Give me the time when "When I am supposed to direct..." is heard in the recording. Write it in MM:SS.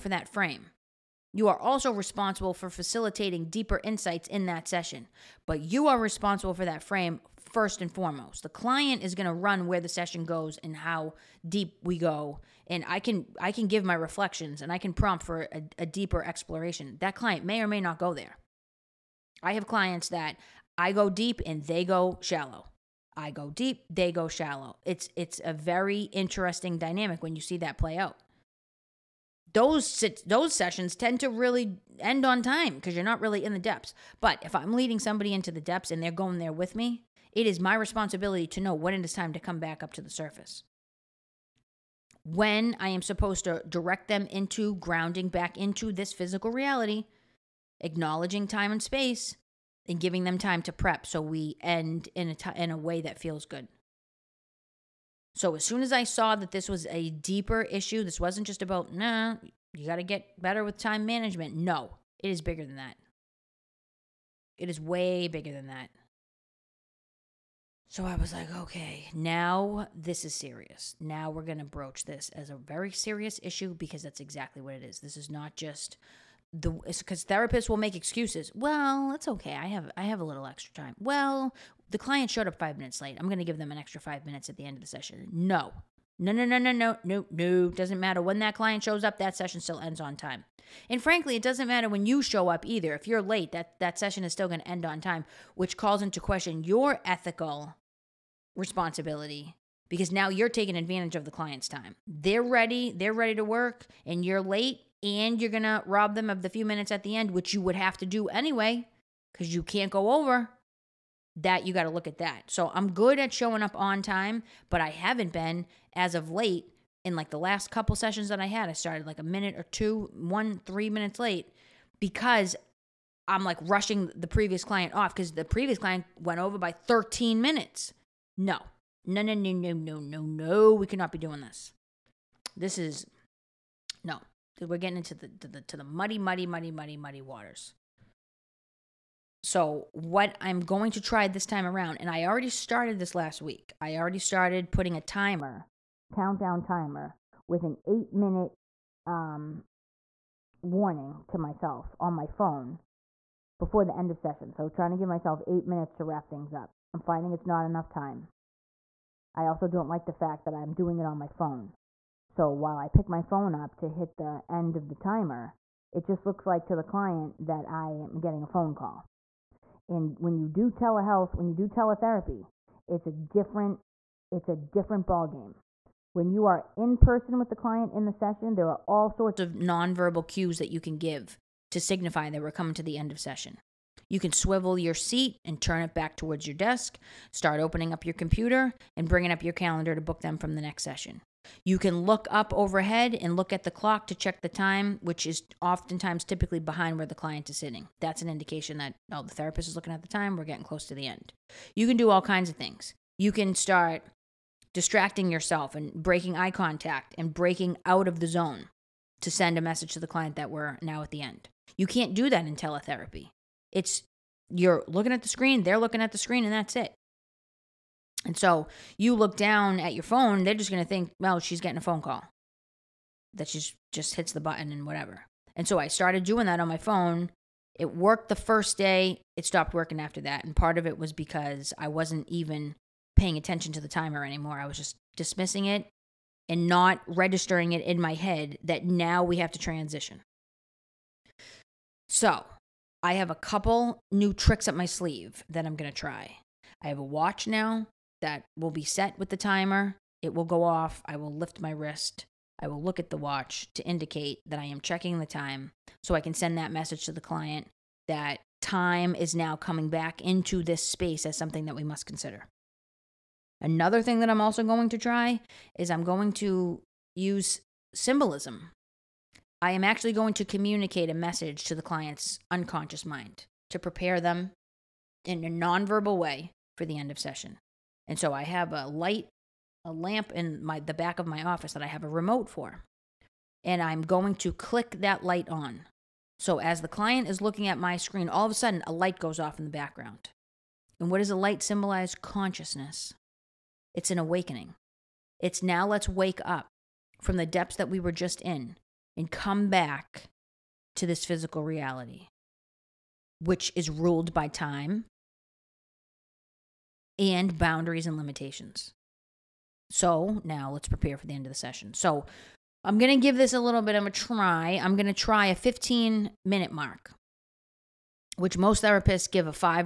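00:42.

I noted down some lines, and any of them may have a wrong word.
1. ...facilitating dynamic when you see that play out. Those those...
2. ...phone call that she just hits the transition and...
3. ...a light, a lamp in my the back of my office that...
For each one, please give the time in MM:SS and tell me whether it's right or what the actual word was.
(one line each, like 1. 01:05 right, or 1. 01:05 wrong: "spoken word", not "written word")
1. 00:26 wrong: "interesting", not "facilitating"
2. 03:41 wrong: "button", not "transition"
3. 04:38 right.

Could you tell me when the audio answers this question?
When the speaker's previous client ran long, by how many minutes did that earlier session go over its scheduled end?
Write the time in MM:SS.
02:06.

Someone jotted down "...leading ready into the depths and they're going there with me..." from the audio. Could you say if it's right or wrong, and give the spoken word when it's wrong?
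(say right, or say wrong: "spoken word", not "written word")
wrong: "somebody", not "ready".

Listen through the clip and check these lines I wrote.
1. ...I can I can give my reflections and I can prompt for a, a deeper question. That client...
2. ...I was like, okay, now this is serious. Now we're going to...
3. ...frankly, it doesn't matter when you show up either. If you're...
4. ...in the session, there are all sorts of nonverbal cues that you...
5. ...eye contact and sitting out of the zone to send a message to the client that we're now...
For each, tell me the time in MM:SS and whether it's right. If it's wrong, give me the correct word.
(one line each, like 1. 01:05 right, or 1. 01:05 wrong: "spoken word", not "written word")
1. 00:12 wrong: "exploration", not "question"
2. 01:08 right
3. 01:31 right
4. 02:57 right
5. 03:26 wrong: "breaking", not "sitting".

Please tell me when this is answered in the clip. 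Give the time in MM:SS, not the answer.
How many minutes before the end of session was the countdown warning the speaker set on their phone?
02:27.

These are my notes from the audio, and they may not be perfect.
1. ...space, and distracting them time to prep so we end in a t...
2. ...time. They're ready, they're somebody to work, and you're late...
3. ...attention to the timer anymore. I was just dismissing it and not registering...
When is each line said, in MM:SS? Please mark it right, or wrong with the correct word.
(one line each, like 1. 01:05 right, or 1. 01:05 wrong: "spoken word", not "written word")
1. 00:48 wrong: "giving", not "distracting"
2. 01:41 wrong: "ready", not "somebody"
3. 03:53 right.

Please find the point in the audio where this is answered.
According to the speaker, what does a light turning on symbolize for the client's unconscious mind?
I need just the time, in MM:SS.
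04:52.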